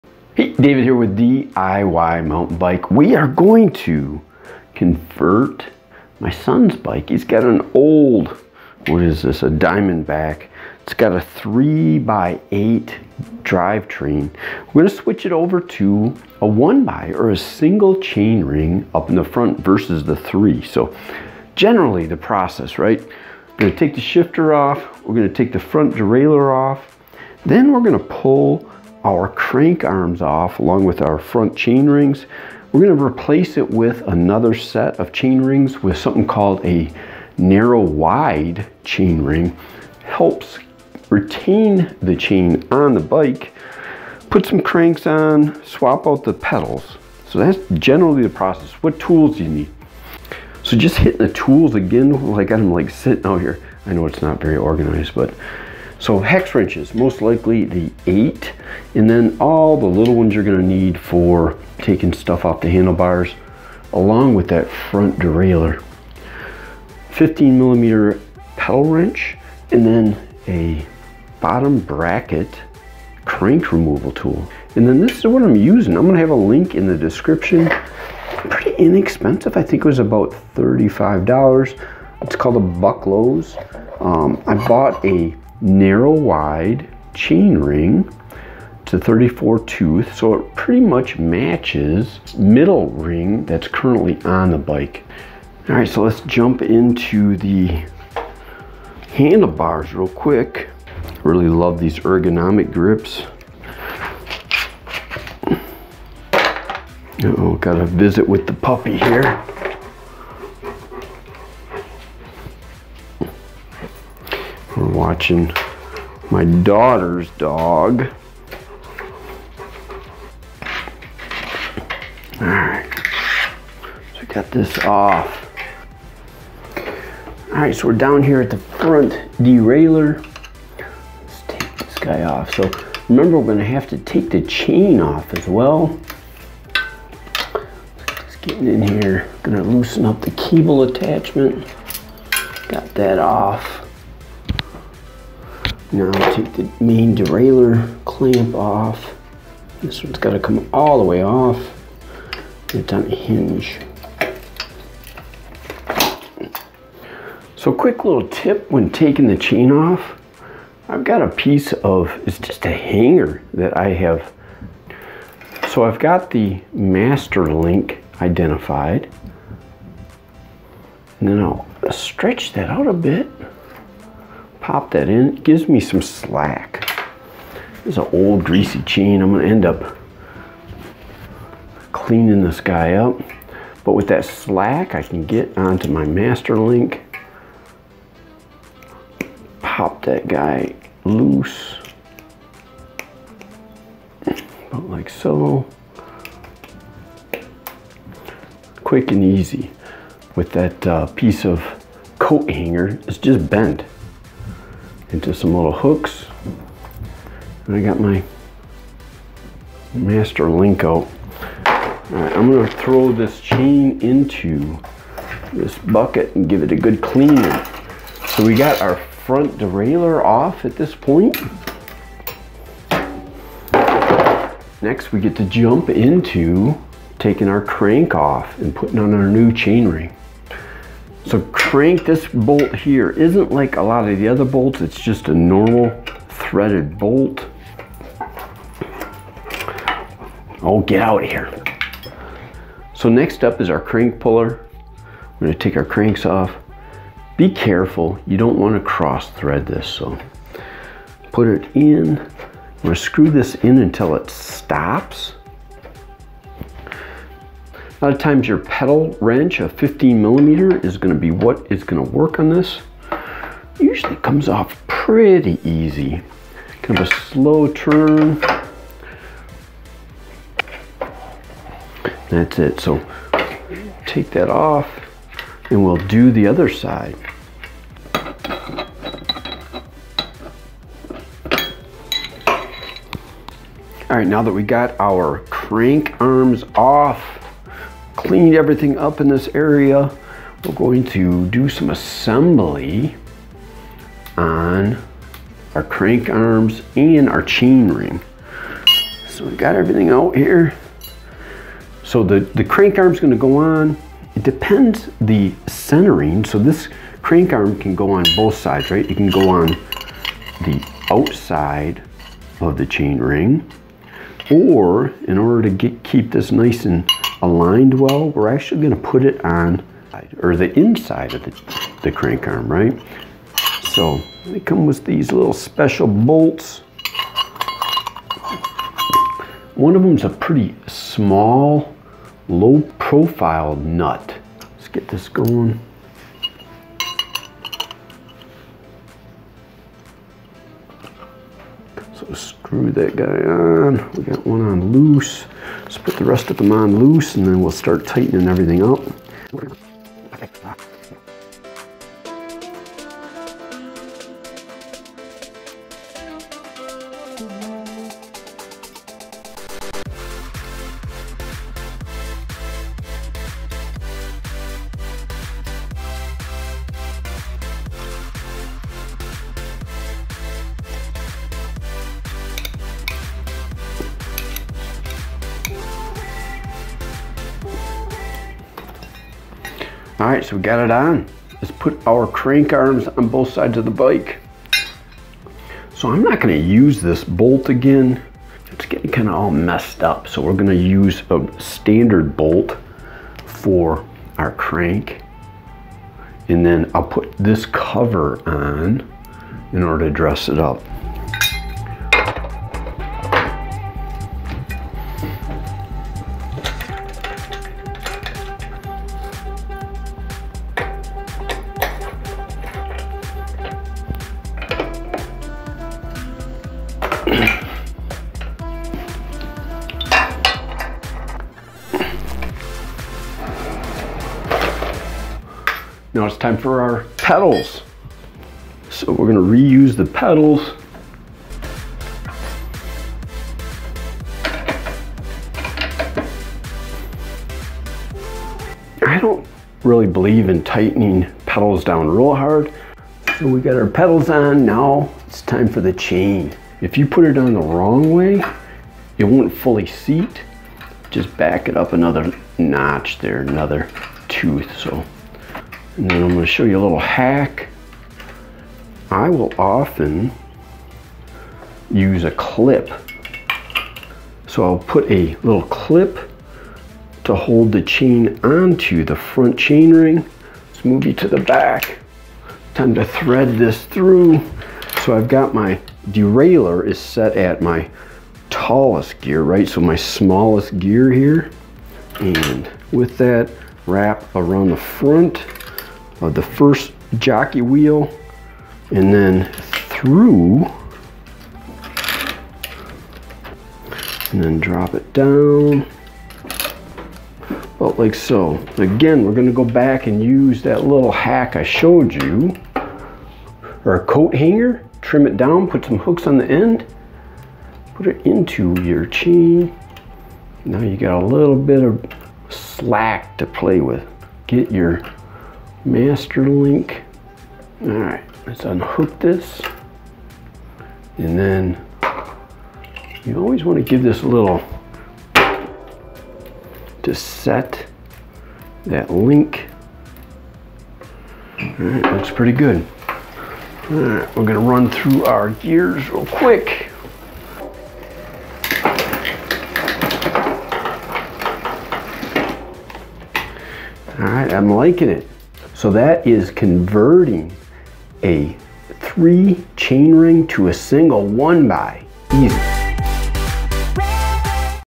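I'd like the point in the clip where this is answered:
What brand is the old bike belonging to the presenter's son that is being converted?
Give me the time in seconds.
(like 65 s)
9 s.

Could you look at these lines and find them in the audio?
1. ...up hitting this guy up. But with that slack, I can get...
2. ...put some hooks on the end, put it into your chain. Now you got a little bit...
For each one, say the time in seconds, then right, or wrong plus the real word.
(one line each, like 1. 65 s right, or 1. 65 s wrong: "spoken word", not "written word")
1. 179 s wrong: "cleaning", not "hitting"
2. 505 s right.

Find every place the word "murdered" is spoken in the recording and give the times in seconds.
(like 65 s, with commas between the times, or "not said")
not said.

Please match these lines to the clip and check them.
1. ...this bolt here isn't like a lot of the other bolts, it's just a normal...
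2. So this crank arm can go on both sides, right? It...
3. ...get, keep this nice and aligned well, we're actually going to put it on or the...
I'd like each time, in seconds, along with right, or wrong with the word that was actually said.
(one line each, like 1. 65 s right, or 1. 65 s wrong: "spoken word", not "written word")
1. 232 s right
2. 306 s right
3. 315 s right.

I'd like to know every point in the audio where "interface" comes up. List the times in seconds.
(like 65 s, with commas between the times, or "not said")
not said.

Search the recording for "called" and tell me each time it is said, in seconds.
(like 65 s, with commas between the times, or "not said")
36 s, 82 s.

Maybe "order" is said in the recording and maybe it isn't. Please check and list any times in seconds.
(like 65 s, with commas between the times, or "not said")
315 s, 399 s.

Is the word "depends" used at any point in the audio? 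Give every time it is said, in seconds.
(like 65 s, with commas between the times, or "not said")
304 s.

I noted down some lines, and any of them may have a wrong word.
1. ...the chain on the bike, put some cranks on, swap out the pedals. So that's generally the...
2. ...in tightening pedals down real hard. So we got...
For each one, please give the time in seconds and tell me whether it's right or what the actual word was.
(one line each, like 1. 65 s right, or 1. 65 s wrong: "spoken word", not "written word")
1. 42 s right
2. 440 s right.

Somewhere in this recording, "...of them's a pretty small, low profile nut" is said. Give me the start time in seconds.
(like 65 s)
329 s.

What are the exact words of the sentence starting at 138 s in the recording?
Just getting in here, gonna loosen up the cable attachment.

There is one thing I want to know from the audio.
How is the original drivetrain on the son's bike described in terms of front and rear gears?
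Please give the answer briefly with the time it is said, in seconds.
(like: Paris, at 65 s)
3 by 8, at 11 s.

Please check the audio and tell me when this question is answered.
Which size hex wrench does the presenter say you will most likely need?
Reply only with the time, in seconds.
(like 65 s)
58 s.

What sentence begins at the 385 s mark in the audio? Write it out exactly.
So I'm not gonna use this bolt again.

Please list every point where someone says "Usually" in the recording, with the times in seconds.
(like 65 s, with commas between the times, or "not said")
263 s.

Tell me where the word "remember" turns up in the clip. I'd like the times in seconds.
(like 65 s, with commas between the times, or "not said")
133 s.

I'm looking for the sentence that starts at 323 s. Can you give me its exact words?
So they come with these little special bolts.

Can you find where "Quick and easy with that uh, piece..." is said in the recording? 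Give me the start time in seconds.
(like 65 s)
198 s.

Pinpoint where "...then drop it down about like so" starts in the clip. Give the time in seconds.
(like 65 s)
494 s.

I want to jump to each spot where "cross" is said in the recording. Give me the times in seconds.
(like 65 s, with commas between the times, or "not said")
248 s.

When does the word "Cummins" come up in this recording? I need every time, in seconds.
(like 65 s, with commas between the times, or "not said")
not said.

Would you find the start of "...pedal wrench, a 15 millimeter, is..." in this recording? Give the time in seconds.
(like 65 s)
258 s.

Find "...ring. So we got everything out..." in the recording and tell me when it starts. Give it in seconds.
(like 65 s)
297 s.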